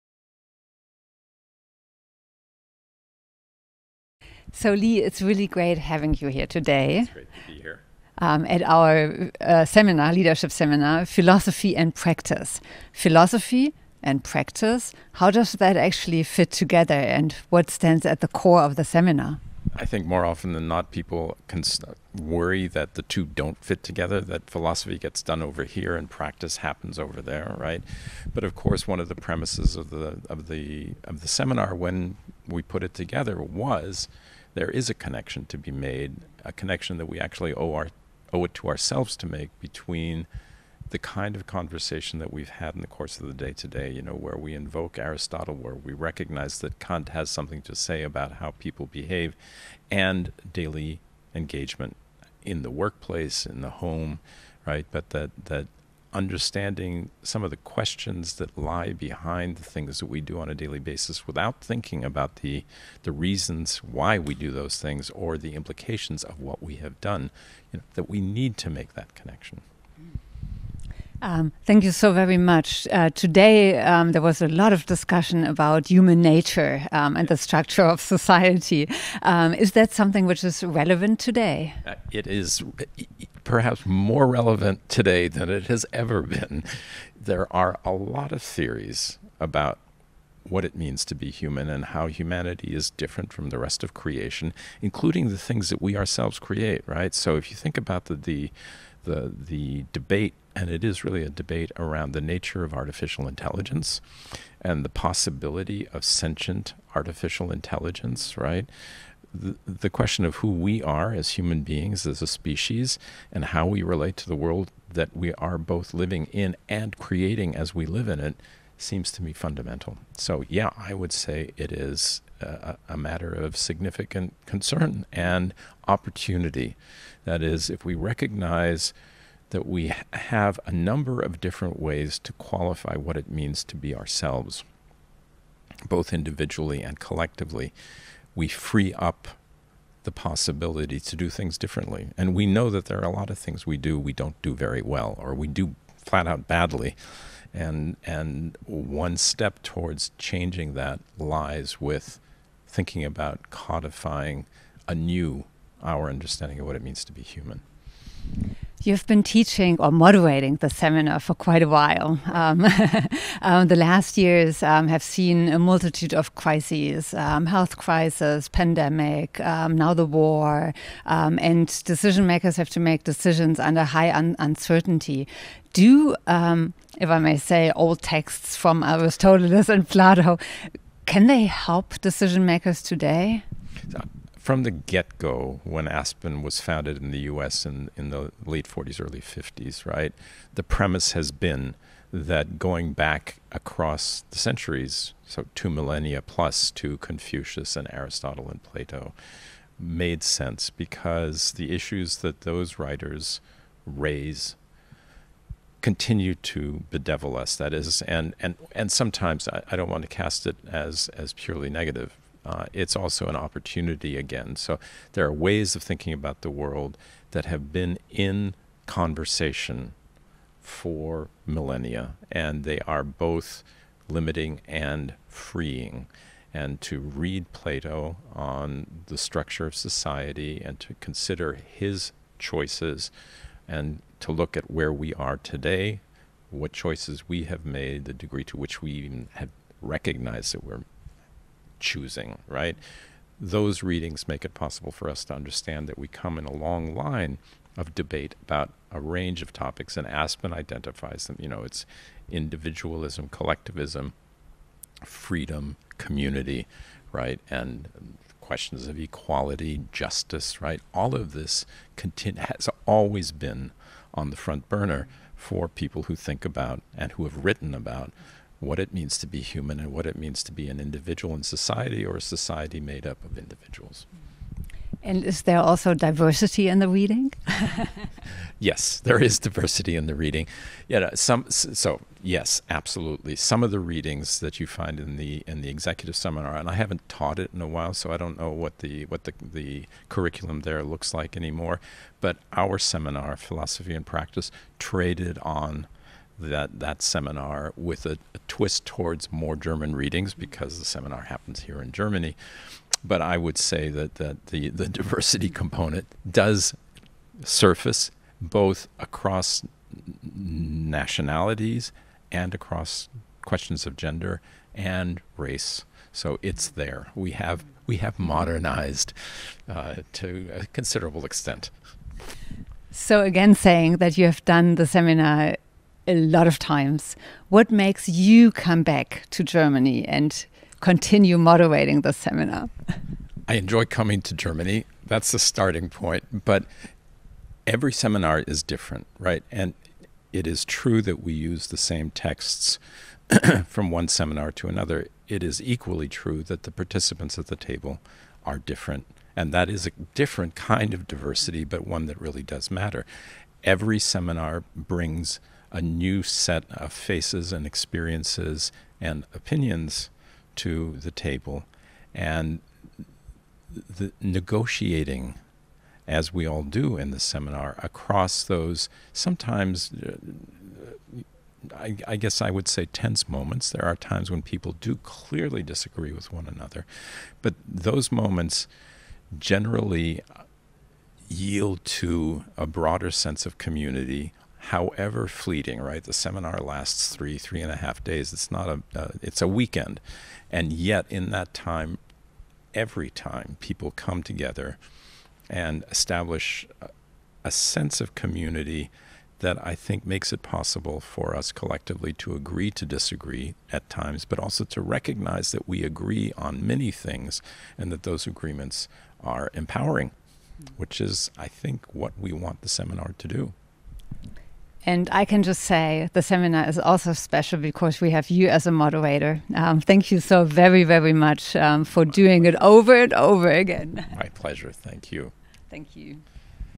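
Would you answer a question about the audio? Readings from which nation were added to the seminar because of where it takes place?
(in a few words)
German readings.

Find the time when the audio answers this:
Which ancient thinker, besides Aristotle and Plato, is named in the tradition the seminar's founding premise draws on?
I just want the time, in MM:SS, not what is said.
03:16.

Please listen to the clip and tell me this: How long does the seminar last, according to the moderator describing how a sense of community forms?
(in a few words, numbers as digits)
3 and a half days.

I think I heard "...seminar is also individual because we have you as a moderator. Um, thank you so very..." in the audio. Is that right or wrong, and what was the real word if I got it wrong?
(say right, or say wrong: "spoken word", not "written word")
wrong: "special", not "individual".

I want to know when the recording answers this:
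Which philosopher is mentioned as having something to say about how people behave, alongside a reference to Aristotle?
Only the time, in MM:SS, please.
00:46.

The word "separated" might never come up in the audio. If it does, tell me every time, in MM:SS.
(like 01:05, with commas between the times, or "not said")
not said.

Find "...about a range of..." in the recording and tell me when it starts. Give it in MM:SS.
04:08.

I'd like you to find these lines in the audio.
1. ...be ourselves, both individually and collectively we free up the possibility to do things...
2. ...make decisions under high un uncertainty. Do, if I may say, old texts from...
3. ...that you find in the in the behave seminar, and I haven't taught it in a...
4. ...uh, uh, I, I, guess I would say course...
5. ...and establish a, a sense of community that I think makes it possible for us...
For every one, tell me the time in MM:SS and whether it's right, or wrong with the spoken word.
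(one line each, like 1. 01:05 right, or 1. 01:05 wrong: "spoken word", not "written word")
1. 02:13 right
2. 02:52 right
3. 04:44 wrong: "executive", not "behave"
4. 06:10 wrong: "tense", not "course"
5. 06:35 right.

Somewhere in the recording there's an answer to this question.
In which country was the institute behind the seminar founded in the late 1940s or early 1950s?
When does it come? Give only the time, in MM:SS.
03:07.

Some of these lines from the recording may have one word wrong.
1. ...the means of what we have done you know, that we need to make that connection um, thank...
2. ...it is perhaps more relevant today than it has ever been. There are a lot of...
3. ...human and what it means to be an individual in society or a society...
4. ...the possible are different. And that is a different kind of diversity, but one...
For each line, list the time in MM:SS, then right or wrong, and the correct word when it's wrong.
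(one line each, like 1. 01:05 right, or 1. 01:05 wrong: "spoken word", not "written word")
1. 01:05 wrong: "implications", not "means"
2. 01:22 right
3. 04:29 right
4. 05:47 wrong: "table", not "possible".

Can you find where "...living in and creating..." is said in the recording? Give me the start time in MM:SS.
01:55.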